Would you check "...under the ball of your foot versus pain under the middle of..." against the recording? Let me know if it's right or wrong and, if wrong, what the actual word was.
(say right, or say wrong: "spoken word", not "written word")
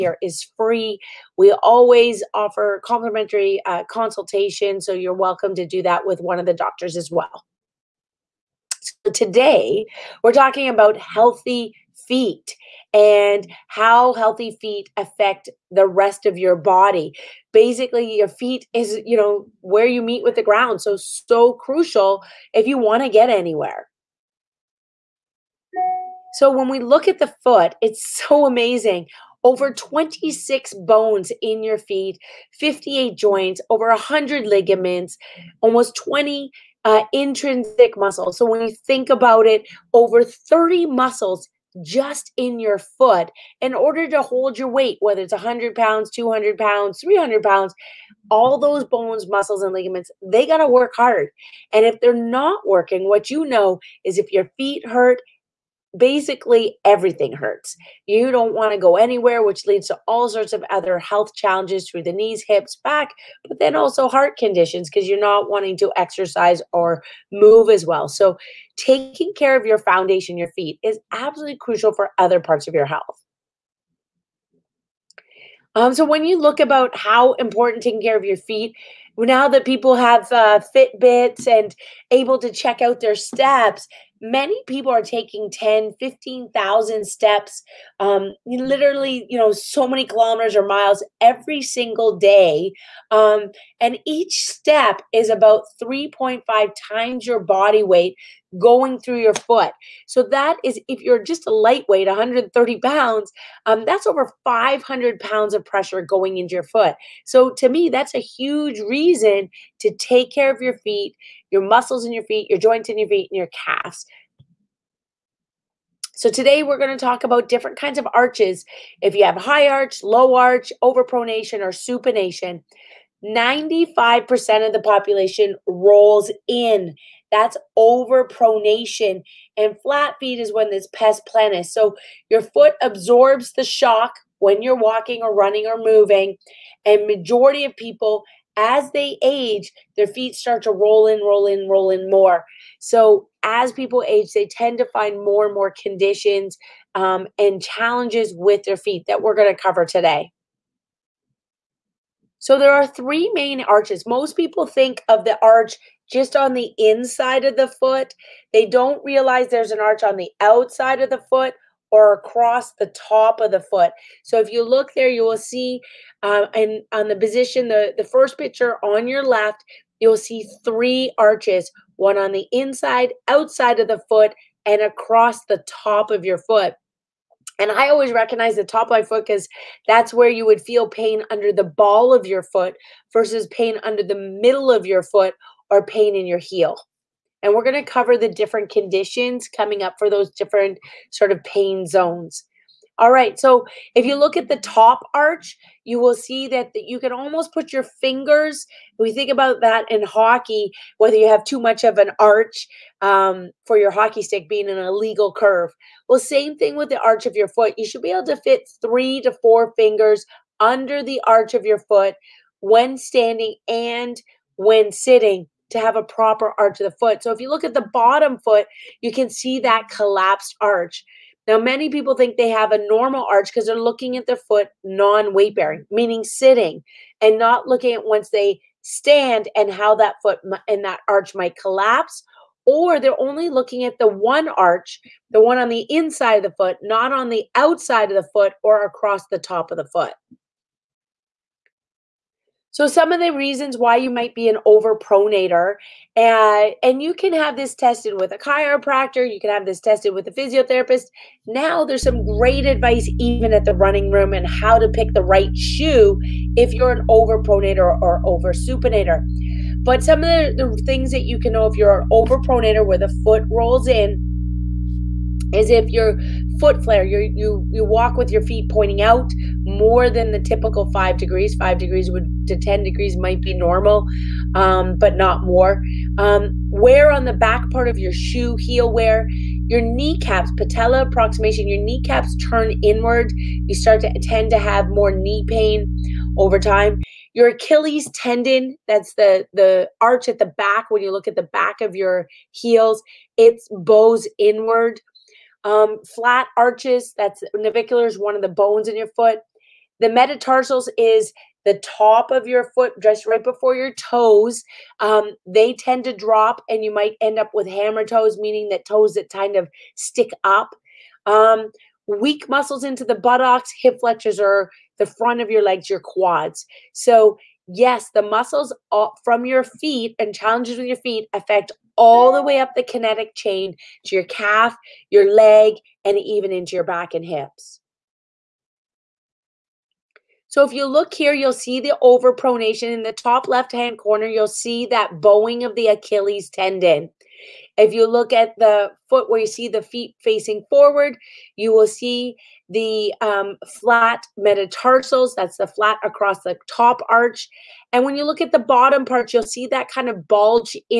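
right.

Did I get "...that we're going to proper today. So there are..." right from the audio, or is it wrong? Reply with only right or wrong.
wrong.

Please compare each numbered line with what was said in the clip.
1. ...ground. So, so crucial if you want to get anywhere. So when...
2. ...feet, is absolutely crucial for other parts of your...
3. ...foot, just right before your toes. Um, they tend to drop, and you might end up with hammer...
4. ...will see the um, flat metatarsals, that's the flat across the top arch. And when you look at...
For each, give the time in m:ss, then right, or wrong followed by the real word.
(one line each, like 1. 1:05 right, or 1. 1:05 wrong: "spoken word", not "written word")
1. 0:20 right
2. 1:10 right
3. 5:02 right
4. 5:41 right.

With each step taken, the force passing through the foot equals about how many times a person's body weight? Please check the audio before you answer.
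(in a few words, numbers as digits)
3.5.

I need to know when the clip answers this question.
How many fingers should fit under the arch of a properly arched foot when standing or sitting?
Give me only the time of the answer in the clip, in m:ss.
3:28.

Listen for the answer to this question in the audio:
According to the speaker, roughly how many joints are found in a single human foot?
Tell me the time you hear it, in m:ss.
0:32.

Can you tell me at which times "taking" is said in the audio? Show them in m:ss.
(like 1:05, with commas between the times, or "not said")
1:08, 1:17, 1:25.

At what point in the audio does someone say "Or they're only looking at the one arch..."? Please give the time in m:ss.
3:52.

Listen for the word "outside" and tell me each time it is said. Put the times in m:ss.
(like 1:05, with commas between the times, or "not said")
2:40, 2:53, 3:57.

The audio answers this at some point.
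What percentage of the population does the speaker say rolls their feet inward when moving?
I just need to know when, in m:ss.
2:03.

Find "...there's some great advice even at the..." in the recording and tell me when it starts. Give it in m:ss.
4:11.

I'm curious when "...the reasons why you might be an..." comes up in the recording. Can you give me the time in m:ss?
4:03.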